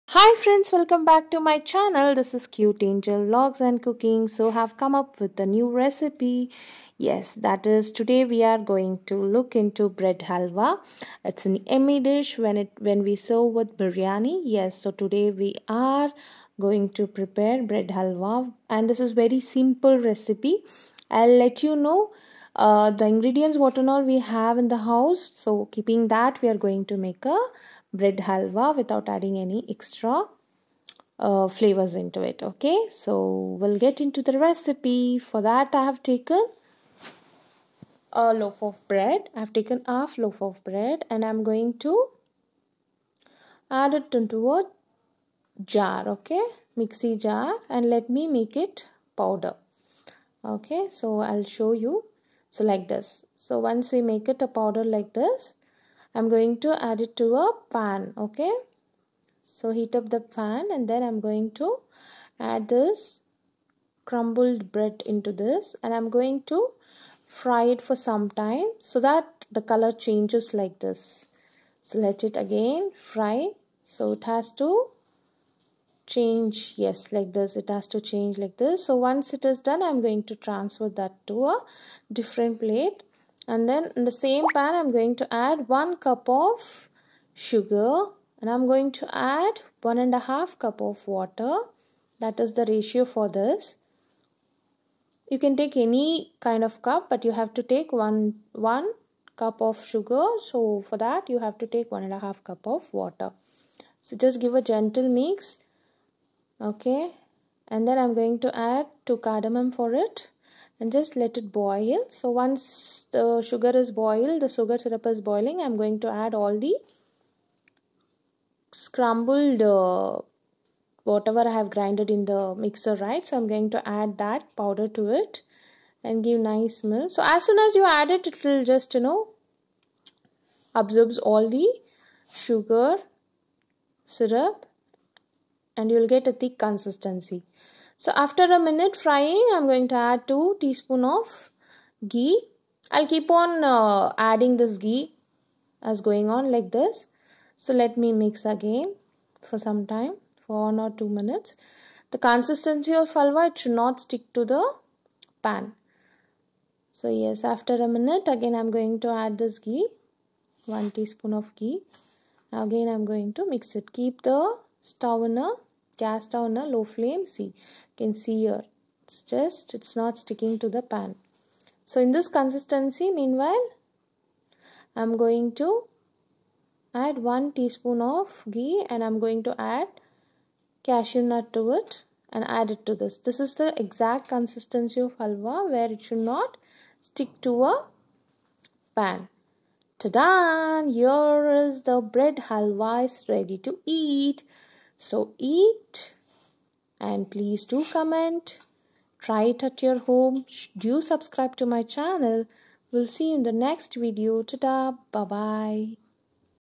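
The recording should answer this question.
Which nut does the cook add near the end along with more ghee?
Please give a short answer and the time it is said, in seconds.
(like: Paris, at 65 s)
Cashew nut, at 180 s.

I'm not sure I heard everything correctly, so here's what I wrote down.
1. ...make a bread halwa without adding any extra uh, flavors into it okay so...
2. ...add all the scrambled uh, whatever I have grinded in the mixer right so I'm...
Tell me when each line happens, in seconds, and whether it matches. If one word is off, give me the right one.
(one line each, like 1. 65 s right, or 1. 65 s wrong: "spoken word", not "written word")
1. 26 s right
2. 116 s right.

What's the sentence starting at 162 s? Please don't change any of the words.
Now again I'm going to mix it.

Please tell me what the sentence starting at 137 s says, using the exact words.
So after a minute frying, I'm going to add 2 teaspoon of ghee.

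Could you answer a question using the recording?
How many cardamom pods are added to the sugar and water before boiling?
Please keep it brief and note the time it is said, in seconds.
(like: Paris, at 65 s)
2, at 109 s.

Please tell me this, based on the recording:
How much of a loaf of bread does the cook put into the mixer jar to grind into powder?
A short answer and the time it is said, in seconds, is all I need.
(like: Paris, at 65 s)
Half loaf, at 39 s.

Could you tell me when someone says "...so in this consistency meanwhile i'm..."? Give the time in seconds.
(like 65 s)
171 s.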